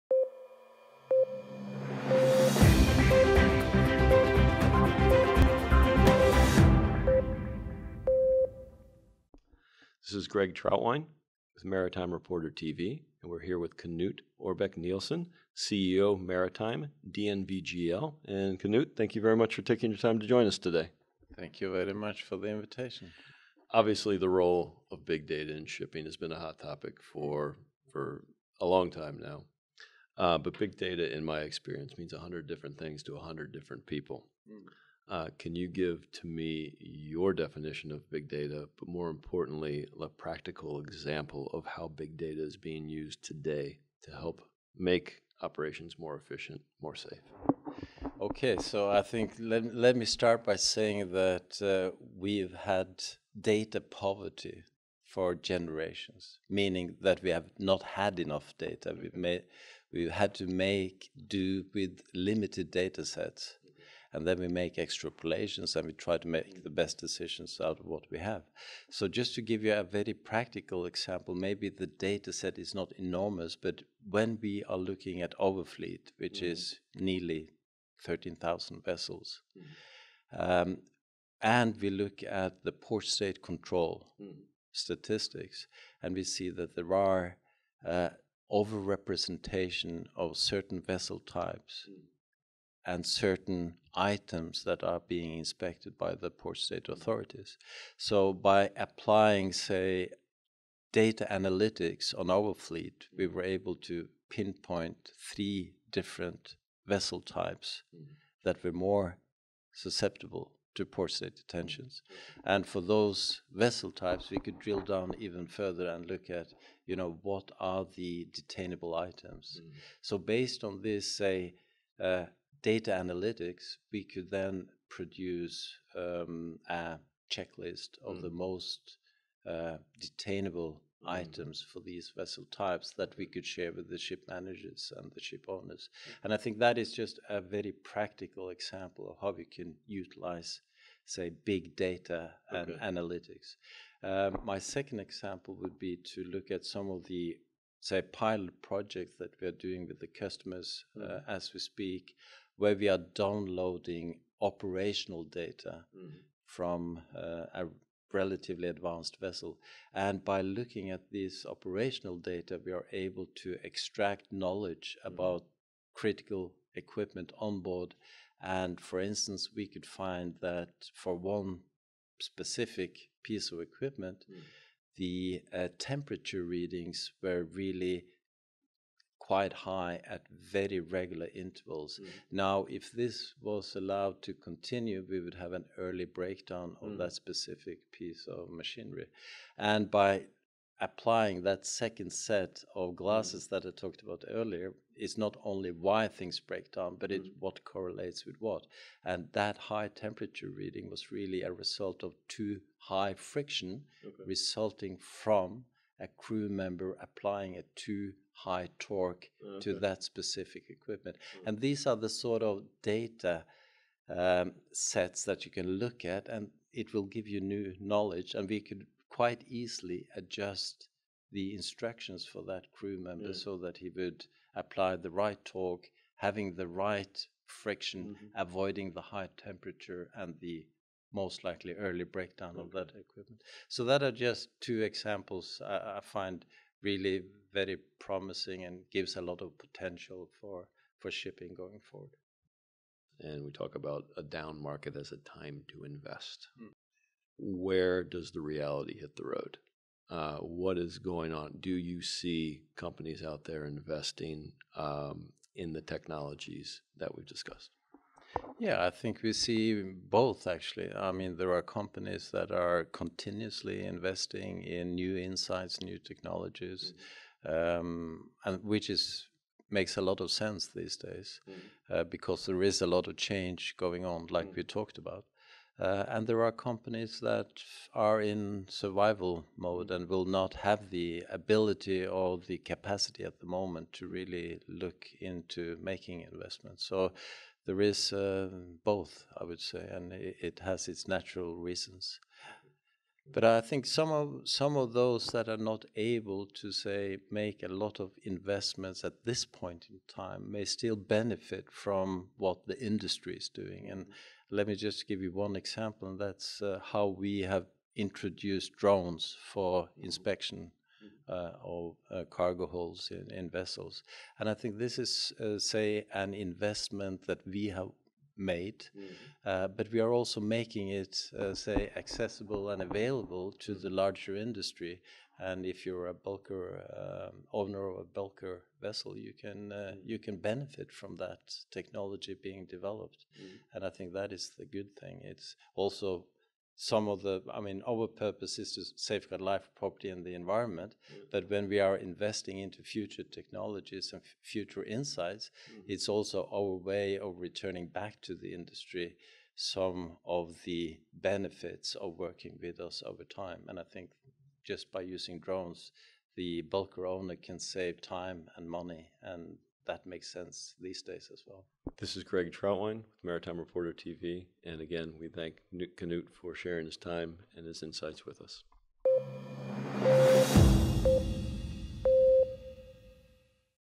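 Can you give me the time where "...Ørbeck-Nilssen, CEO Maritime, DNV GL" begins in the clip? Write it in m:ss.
0:14.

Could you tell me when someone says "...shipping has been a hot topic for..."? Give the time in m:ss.
0:25.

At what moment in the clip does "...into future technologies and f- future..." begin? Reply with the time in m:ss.
5:42.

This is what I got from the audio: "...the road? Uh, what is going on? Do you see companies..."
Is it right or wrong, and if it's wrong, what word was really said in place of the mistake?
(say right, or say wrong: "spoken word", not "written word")
right.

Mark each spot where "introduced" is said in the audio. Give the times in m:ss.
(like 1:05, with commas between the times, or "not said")
5:07.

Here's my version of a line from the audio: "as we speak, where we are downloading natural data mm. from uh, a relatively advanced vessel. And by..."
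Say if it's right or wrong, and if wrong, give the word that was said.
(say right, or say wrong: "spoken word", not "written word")
wrong: "operational", not "natural".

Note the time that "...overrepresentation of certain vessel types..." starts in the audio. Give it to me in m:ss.
1:28.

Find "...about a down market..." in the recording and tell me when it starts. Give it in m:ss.
4:03.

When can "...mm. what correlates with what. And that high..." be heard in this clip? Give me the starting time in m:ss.
3:17.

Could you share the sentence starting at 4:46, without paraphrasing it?
So there is uh, both, I would say, and it, it has its natural reasons.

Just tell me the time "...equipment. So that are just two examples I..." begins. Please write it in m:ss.
3:53.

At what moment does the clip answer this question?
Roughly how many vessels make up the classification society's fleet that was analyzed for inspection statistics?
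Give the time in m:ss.
1:18.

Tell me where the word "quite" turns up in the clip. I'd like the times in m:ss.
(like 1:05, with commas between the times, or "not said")
2:59, 3:39.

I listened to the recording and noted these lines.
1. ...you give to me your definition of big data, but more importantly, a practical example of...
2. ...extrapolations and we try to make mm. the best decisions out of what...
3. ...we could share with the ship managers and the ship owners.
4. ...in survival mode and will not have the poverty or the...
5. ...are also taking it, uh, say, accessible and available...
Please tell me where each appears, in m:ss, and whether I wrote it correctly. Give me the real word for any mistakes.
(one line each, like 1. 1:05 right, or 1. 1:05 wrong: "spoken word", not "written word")
1. 0:35 right
2. 1:04 right
3. 2:13 right
4. 4:38 wrong: "ability", not "poverty"
5. 5:20 wrong: "making", not "taking".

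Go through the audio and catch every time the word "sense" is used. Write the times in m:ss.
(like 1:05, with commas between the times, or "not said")
4:30, 6:00.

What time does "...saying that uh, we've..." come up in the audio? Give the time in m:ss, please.
0:50.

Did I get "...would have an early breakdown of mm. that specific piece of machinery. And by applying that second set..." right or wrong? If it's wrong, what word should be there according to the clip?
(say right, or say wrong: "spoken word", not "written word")
right.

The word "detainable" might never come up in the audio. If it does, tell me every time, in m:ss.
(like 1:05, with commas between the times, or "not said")
1:58, 2:09.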